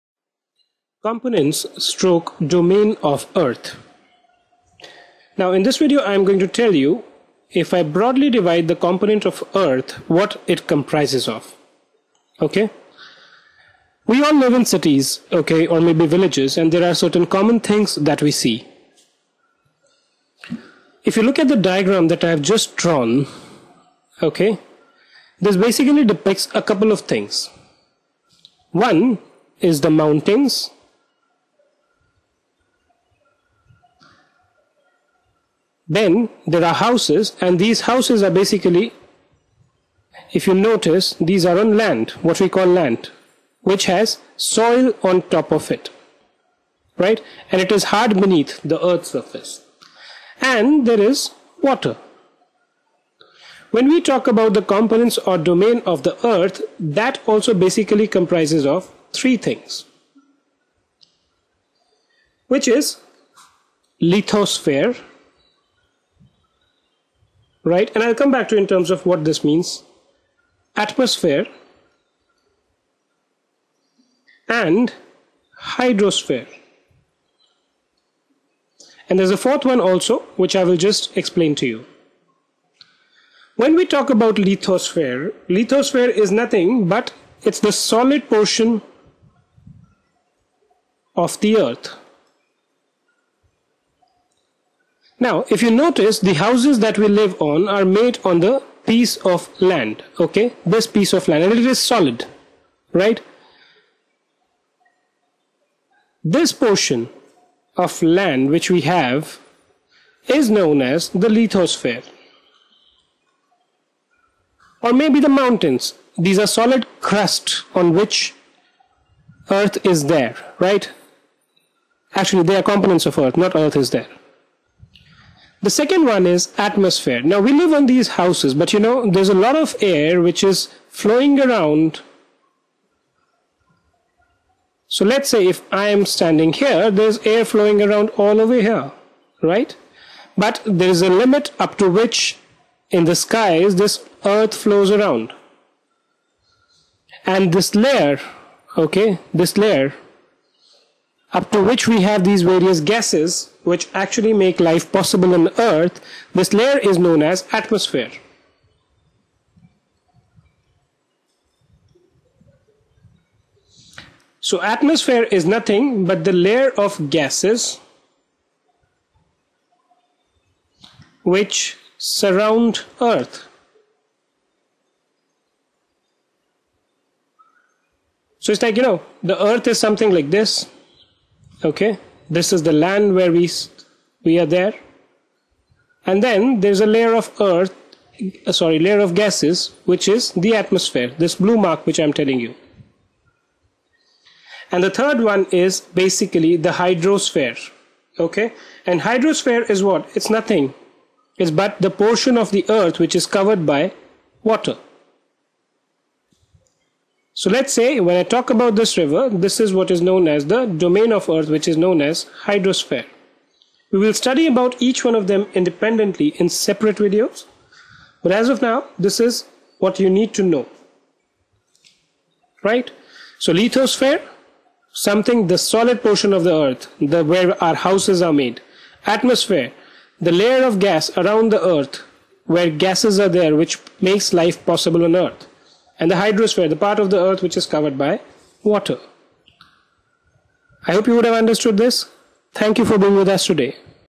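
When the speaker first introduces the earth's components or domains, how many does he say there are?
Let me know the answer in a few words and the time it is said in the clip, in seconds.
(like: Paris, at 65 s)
3, at 59 s.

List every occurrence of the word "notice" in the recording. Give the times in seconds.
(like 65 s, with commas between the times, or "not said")
40 s, 95 s.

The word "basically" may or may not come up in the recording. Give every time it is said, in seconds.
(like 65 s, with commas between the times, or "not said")
25 s, 38 s, 57 s, 195 s.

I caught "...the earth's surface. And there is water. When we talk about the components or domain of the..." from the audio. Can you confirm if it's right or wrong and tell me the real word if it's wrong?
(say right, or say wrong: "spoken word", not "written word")
right.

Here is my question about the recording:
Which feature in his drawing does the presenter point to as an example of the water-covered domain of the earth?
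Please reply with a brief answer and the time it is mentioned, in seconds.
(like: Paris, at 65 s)
river, at 208 s.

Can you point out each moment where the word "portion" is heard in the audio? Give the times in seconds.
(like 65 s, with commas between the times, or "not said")
88 s, 106 s, 201 s, 226 s.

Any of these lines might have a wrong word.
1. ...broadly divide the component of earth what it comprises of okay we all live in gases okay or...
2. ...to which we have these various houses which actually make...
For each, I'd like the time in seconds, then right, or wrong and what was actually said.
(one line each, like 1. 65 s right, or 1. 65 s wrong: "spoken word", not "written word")
1. 7 s wrong: "cities", not "gases"
2. 151 s wrong: "gases", not "houses".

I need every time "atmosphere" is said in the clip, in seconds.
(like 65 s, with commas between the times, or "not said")
70 s, 126 s, 157 s, 164 s, 190 s, 229 s.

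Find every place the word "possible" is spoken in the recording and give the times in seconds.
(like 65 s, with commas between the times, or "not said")
154 s, 234 s.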